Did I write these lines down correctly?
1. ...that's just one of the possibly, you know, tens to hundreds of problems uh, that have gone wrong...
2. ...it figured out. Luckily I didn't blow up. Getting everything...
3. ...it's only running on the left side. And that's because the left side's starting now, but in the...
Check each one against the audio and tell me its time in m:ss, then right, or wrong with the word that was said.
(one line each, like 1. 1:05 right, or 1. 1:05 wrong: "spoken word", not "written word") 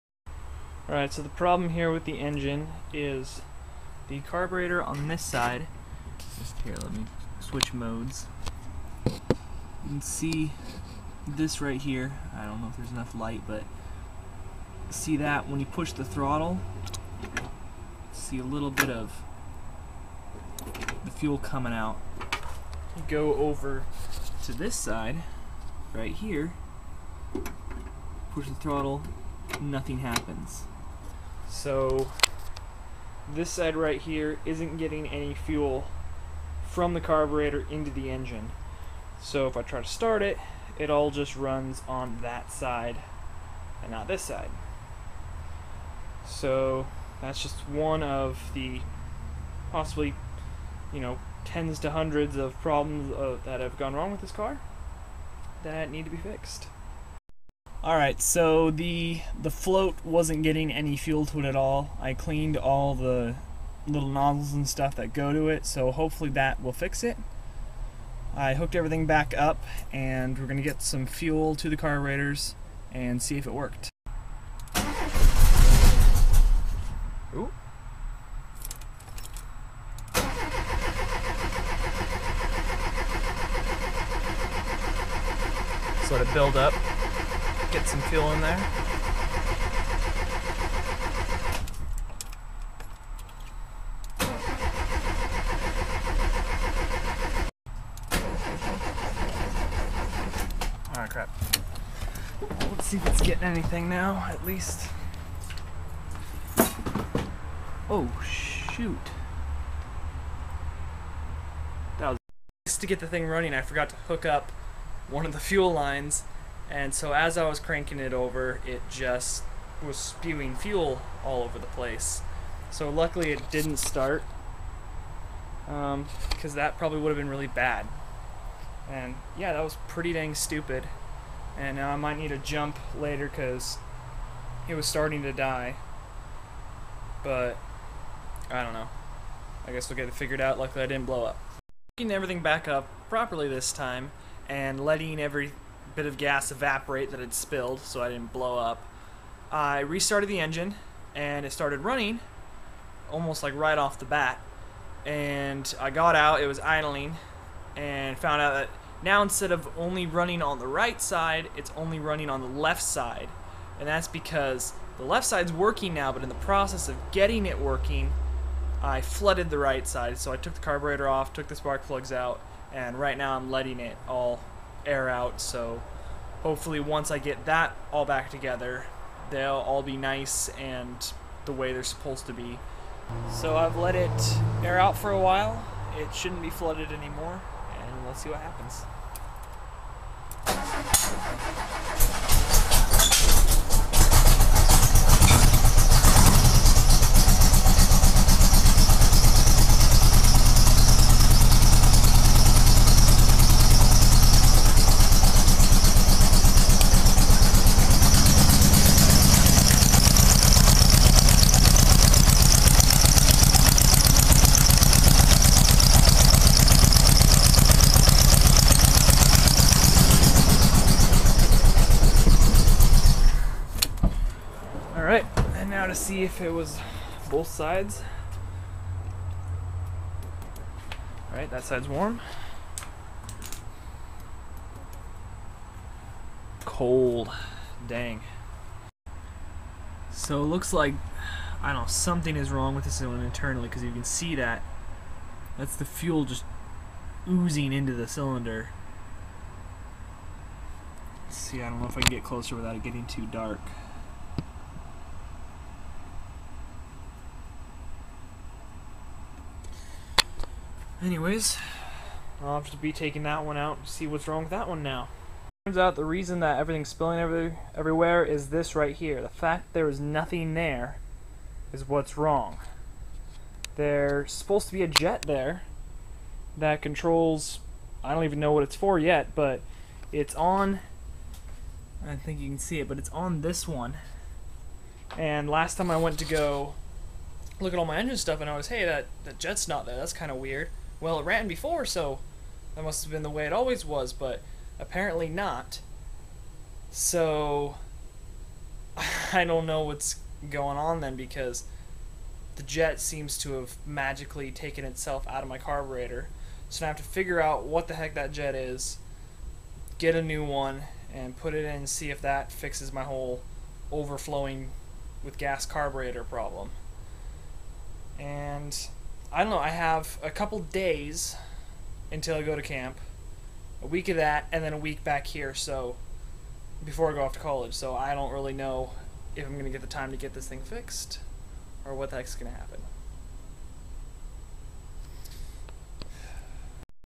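1. 0:47 right
2. 2:20 right
3. 2:41 wrong: "working", not "starting".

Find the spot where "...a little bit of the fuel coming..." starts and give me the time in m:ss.
0:18.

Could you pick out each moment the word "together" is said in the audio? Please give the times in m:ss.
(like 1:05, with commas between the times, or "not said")
2:58.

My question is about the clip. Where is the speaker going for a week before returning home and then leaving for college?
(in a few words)
camp.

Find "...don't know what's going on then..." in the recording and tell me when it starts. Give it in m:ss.
4:59.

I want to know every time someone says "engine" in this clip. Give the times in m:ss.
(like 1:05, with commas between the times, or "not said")
0:02, 0:38, 2:30, 4:47.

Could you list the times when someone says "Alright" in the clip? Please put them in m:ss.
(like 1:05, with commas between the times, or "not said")
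0:00, 1:40, 3:51.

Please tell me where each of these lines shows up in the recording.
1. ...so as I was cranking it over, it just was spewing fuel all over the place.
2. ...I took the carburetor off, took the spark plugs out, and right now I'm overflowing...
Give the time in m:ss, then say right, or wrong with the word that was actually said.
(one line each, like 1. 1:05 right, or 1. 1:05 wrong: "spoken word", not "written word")
1. 1:56 right
2. 2:50 wrong: "letting", not "overflowing".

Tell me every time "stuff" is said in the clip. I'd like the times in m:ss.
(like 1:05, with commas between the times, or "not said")
1:04, 4:48.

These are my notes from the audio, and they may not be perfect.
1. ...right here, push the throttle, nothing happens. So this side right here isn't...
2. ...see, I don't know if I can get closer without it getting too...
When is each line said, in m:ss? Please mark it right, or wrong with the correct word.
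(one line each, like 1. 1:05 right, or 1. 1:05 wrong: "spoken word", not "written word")
1. 0:25 right
2. 4:11 right.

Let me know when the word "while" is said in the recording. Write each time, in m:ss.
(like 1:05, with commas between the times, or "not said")
3:05.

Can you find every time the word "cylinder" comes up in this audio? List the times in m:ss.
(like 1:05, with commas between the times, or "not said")
4:02, 4:08.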